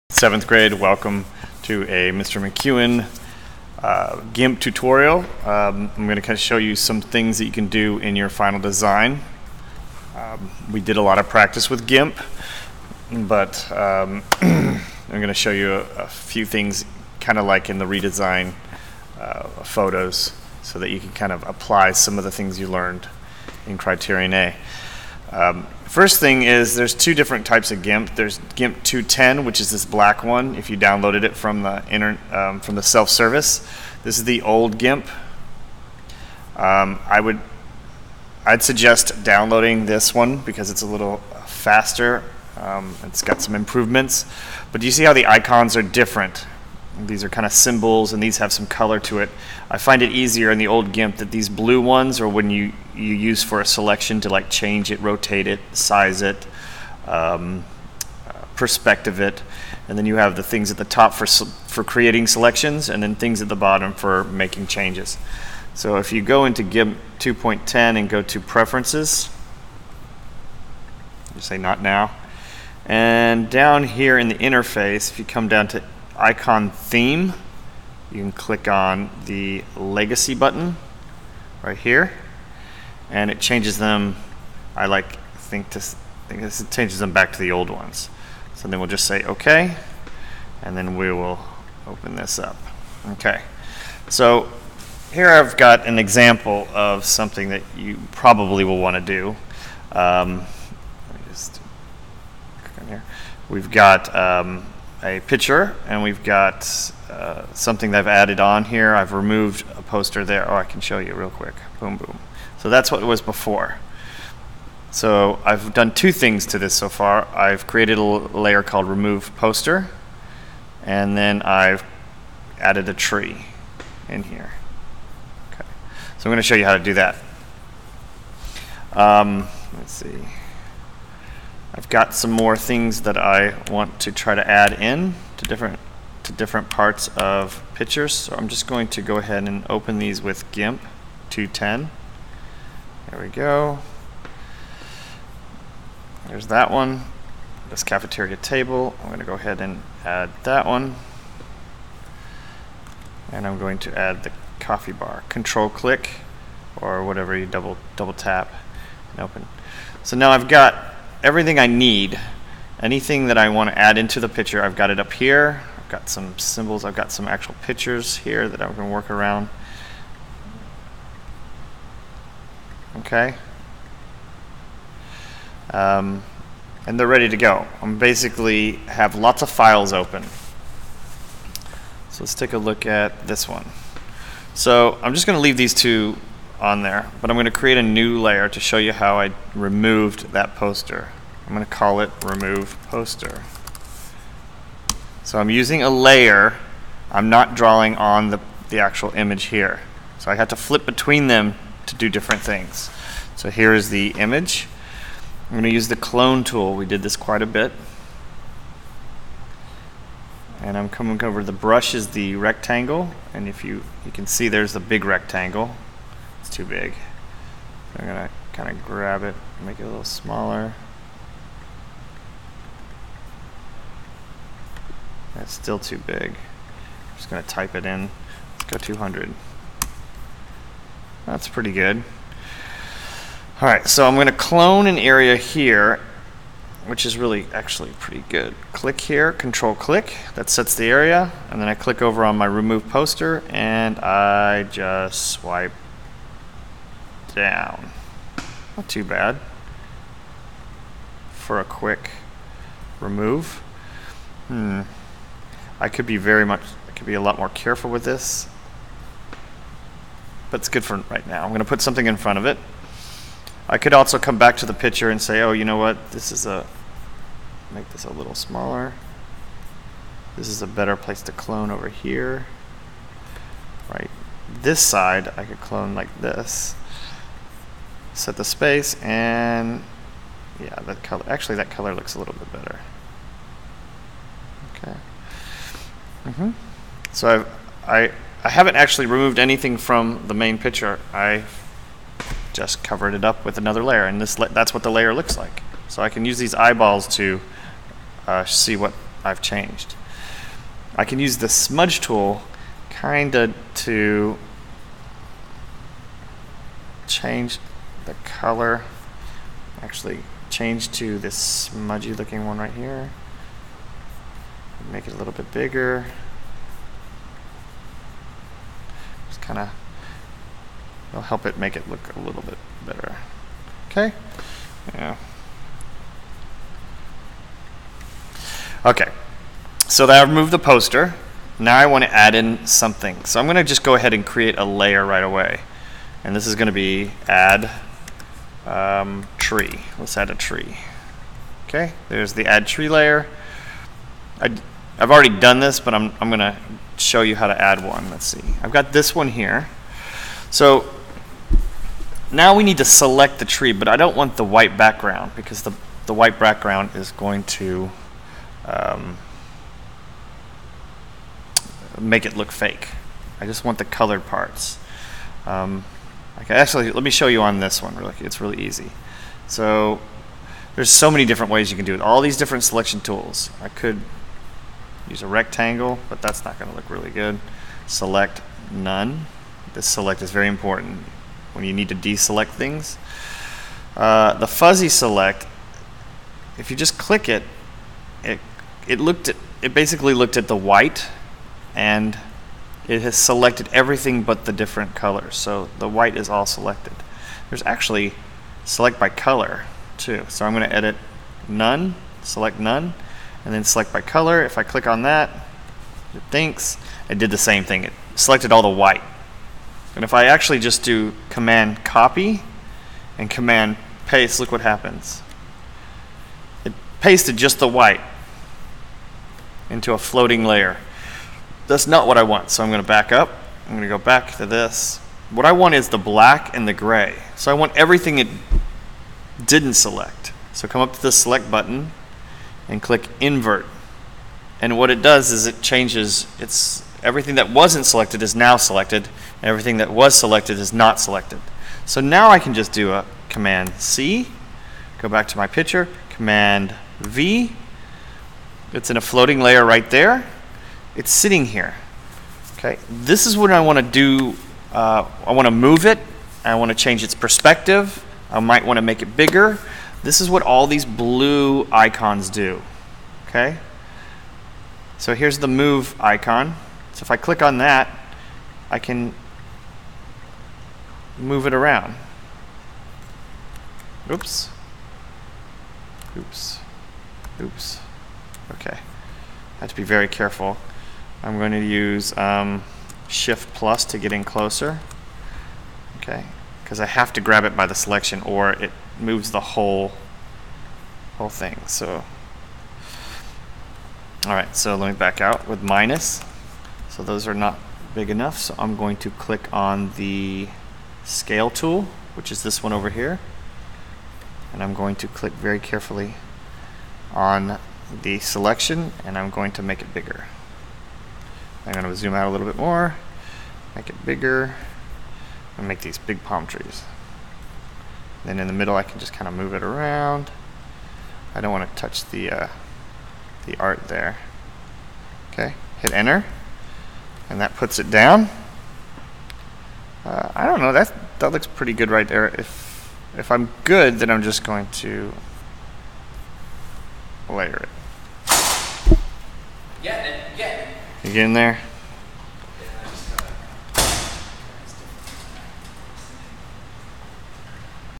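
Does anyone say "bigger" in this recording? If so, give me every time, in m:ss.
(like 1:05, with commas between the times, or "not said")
5:15, 7:39, 8:29, 8:34.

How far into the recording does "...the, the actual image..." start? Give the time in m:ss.
3:18.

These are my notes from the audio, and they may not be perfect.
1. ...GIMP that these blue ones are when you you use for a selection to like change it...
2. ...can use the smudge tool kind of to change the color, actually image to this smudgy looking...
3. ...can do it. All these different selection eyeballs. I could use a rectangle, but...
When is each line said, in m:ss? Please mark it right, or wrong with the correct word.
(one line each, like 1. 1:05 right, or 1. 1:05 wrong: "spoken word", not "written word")
1. 0:50 right
2. 5:01 wrong: "change", not "image"
3. 6:11 wrong: "tools", not "eyeballs".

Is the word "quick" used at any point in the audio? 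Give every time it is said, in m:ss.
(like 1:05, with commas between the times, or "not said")
1:51, 4:11.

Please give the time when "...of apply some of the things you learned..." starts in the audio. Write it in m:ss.
0:21.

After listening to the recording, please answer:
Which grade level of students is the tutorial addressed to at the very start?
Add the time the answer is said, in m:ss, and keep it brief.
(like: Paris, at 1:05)
Seventh grade, at 0:00.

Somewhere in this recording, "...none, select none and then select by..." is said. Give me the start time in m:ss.
6:41.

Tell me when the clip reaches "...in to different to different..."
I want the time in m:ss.
2:14.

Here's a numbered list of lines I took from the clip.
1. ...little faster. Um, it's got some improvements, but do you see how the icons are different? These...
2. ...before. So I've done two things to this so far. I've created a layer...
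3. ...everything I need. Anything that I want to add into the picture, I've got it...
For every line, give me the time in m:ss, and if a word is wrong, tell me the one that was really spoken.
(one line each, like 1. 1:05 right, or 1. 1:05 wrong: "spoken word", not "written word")
1. 0:40 right
2. 1:53 right
3. 2:41 right.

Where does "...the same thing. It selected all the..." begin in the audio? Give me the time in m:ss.
6:47.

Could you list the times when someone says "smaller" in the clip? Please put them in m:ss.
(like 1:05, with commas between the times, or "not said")
3:40, 4:28.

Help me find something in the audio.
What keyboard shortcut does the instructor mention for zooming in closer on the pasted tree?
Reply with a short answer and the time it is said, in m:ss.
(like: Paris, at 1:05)
Shift plus, at 8:03.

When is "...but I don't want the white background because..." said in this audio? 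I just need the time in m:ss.
5:53.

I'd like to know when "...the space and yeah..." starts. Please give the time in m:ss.
4:38.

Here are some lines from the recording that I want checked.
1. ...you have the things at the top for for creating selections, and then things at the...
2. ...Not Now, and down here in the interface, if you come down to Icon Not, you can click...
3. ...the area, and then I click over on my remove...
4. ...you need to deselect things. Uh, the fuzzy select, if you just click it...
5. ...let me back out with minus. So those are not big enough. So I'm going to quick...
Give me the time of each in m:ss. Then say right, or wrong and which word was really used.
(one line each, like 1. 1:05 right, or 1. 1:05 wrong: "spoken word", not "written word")
1. 1:00 right
2. 1:11 wrong: "Theme", not "Not"
3. 4:00 right
4. 6:21 right
5. 8:14 wrong: "click", not "quick".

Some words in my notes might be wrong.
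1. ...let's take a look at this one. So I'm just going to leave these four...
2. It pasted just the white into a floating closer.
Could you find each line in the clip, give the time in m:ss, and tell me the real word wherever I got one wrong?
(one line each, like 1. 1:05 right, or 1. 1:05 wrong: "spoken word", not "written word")
1. 3:02 wrong: "two", not "four"
2. 6:56 wrong: "layer", not "closer".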